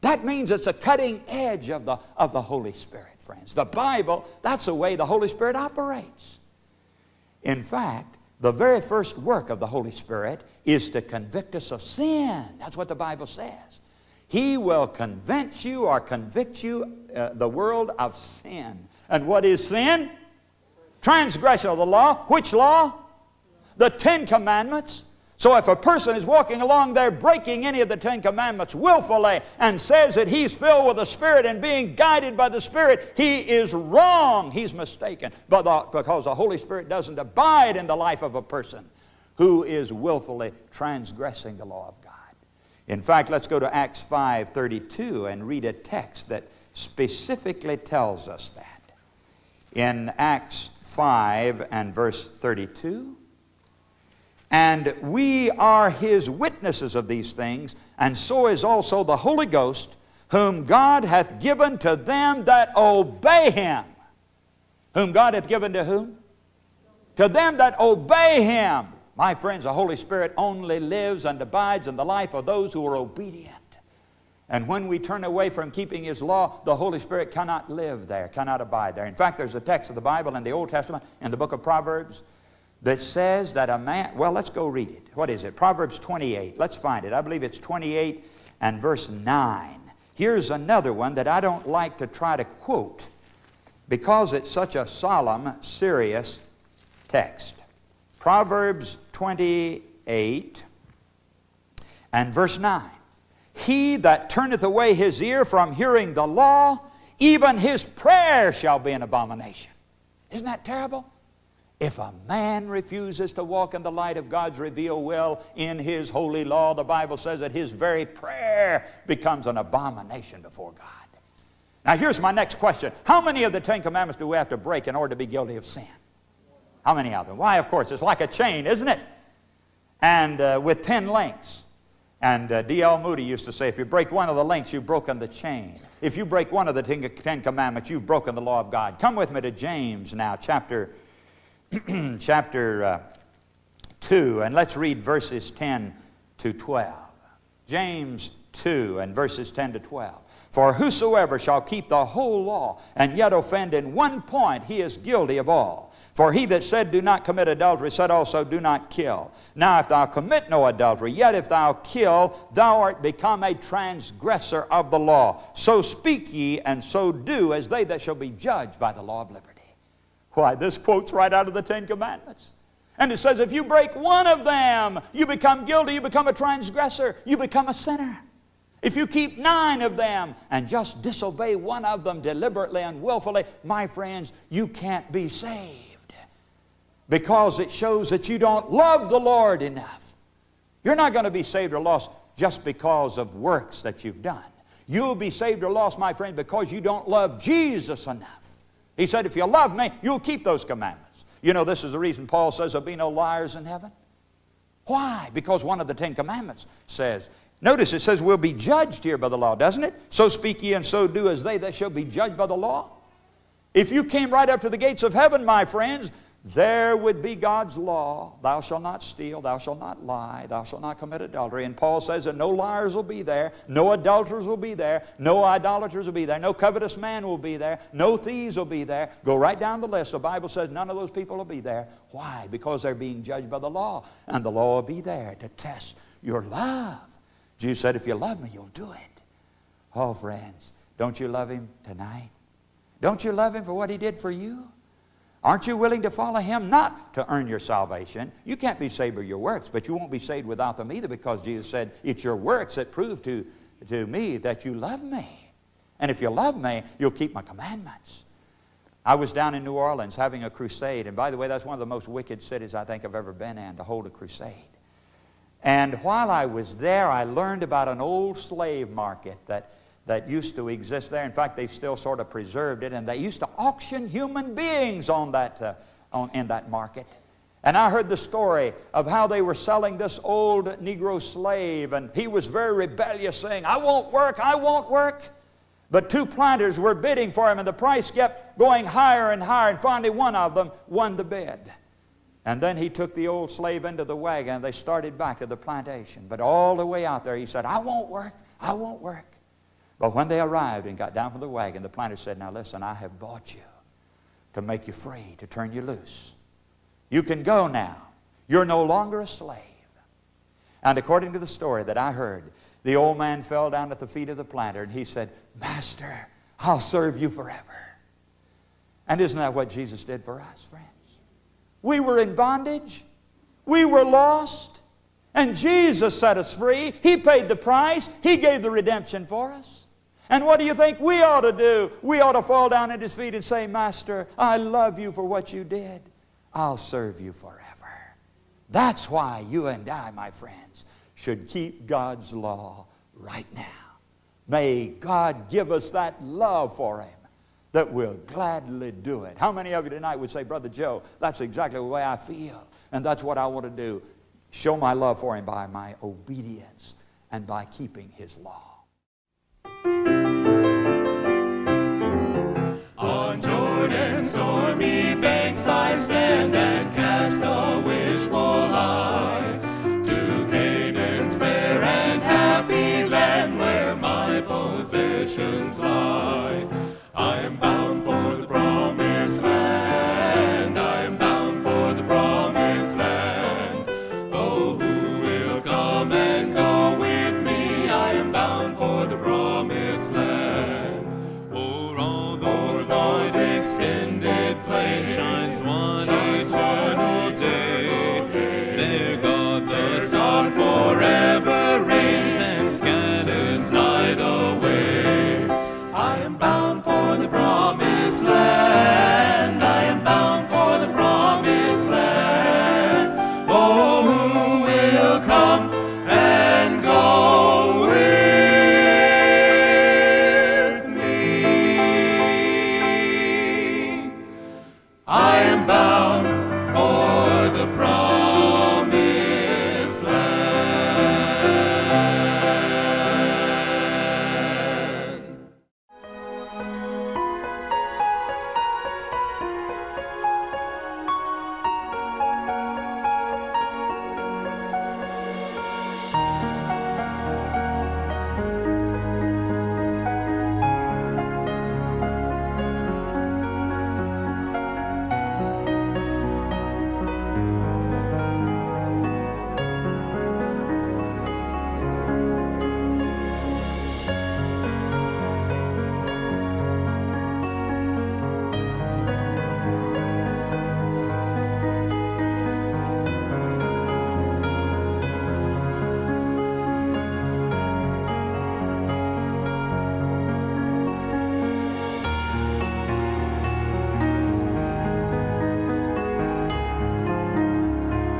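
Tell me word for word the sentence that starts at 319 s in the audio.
And isn't that what Jesus did for us, friends?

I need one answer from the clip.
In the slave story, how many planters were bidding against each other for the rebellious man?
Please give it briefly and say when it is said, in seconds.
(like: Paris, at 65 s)
2, at 286 s.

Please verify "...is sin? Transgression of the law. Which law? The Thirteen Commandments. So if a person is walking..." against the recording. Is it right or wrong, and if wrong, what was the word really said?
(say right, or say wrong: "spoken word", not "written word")
wrong: "Ten", not "Thirteen".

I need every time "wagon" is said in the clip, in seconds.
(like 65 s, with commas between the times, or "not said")
294 s, 301 s.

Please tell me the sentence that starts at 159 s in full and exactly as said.
Now, if thou commit no adultery, yet if thou kill, thou art become a transgressor of the law.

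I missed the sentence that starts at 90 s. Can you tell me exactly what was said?
Here's another one that I don't like to try to quote because it's such a solemn, serious text.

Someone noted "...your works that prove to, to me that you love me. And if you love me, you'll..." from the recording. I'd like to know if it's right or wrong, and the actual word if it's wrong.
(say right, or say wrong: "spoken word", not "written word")
right.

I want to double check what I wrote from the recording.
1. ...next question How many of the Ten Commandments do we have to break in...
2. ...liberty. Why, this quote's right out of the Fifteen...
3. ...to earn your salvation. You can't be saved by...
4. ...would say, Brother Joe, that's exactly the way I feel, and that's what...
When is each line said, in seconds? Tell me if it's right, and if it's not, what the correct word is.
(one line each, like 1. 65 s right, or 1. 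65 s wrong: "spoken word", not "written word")
1. 122 s right
2. 169 s wrong: "Ten", not "Fifteen"
3. 247 s right
4. 350 s right.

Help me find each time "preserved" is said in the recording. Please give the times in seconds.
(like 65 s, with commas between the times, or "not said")
272 s.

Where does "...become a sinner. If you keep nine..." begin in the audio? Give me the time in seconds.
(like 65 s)
177 s.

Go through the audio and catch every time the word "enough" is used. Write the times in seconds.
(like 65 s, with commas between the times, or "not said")
189 s, 198 s.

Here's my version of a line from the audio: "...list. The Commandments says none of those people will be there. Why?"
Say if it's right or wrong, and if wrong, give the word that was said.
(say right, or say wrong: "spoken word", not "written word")
wrong: "Bible", not "Commandments".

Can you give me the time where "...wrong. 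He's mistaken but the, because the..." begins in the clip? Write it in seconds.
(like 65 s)
33 s.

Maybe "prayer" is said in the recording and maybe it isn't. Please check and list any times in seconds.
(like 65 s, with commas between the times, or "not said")
107 s, 118 s.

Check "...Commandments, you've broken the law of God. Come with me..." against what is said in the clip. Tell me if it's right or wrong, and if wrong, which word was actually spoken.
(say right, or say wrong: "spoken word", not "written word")
right.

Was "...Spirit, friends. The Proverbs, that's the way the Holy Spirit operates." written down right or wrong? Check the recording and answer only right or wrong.
wrong.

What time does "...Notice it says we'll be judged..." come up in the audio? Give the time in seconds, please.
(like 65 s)
207 s.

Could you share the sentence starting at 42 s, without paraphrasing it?
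In fact, let's go to Acts 5.32 and read a text that specifically tells us that.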